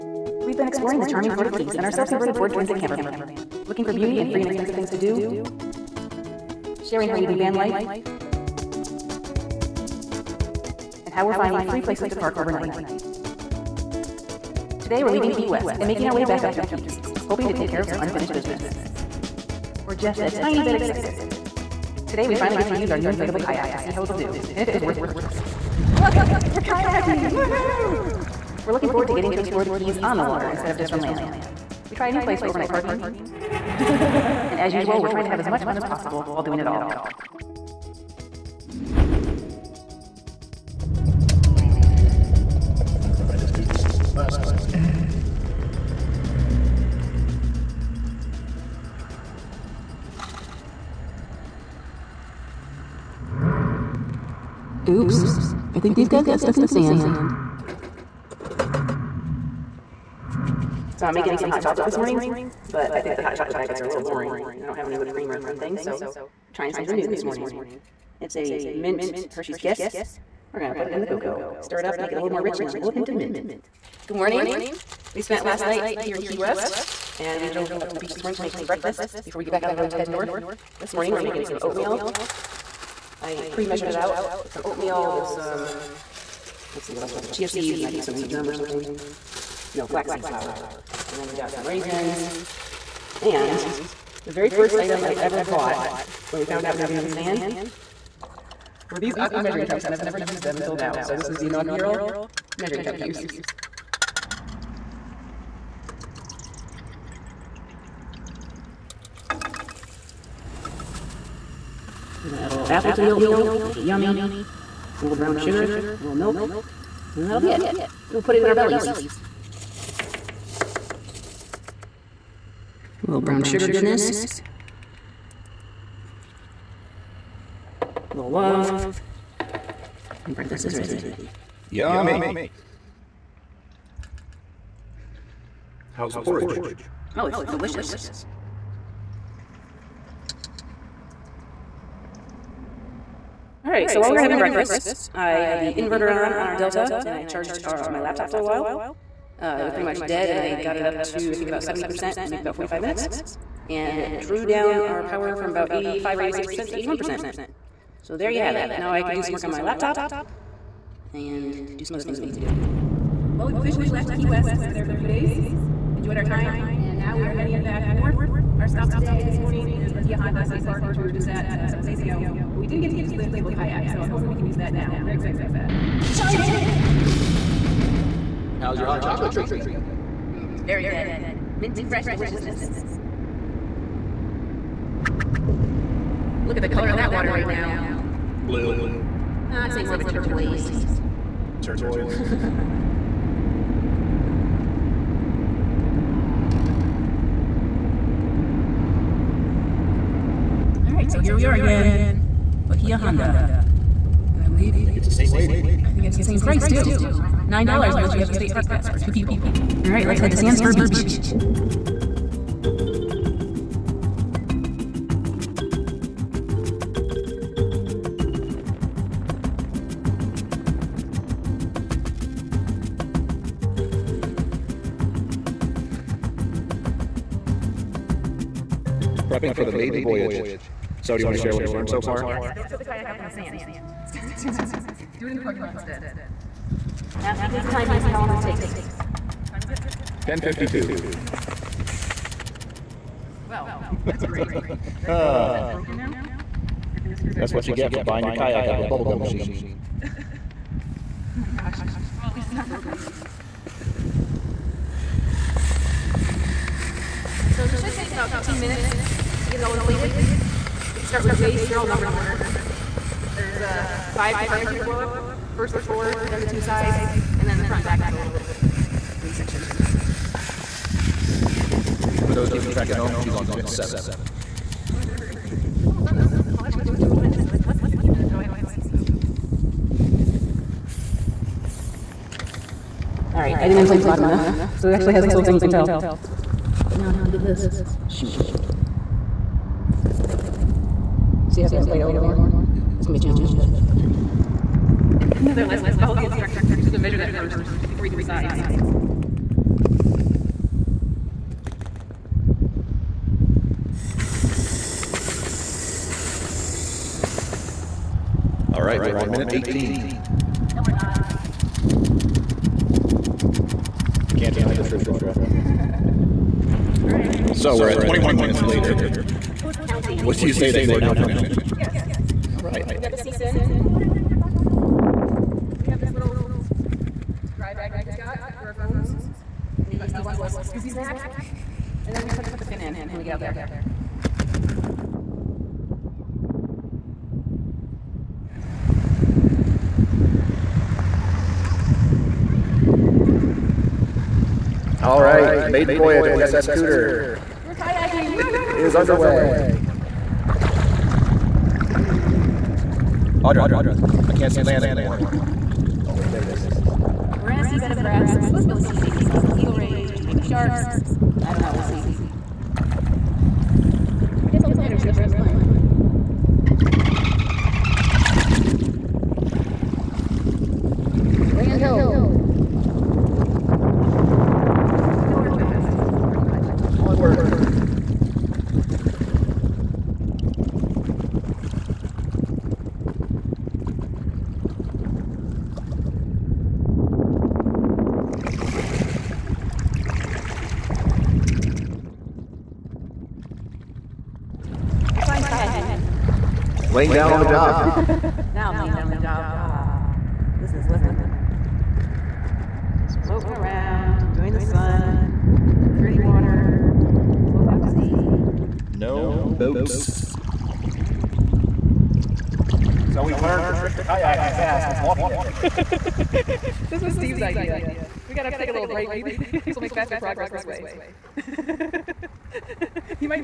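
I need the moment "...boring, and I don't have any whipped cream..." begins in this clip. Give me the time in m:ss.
1:04.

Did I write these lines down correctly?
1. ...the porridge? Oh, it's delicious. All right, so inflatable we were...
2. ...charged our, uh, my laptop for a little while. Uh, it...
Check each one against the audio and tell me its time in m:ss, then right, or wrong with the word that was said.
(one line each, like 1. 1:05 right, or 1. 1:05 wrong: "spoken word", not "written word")
1. 2:16 wrong: "while", not "inflatable"
2. 2:27 right.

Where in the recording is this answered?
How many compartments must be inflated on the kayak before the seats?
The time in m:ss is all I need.
4:24.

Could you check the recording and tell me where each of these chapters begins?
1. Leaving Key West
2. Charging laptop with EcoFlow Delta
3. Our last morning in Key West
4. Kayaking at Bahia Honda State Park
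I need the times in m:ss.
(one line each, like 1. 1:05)
1. 2:42
2. 2:22
3. 0:40
4. 3:15.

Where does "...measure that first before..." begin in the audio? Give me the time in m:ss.
4:56.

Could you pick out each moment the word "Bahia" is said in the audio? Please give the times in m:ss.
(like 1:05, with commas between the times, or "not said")
2:49, 3:22.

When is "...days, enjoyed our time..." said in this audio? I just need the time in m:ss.
2:45.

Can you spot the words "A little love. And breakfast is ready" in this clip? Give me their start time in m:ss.
2:07.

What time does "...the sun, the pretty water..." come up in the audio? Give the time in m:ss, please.
6:44.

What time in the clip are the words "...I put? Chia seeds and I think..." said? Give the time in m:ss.
1:27.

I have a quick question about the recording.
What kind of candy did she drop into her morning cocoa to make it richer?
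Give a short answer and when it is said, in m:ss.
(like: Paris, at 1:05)
Mint Hershey's Kiss, at 1:08.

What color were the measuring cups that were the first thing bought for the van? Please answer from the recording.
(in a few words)
Aqua.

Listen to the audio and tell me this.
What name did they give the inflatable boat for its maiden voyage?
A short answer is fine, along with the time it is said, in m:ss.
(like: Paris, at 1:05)
SS Cooter, at 5:46.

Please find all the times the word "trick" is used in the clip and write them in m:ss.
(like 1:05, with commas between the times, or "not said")
6:53.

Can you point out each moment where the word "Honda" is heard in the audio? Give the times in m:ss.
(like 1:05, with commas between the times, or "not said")
2:50, 3:22.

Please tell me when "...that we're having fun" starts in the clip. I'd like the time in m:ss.
6:05.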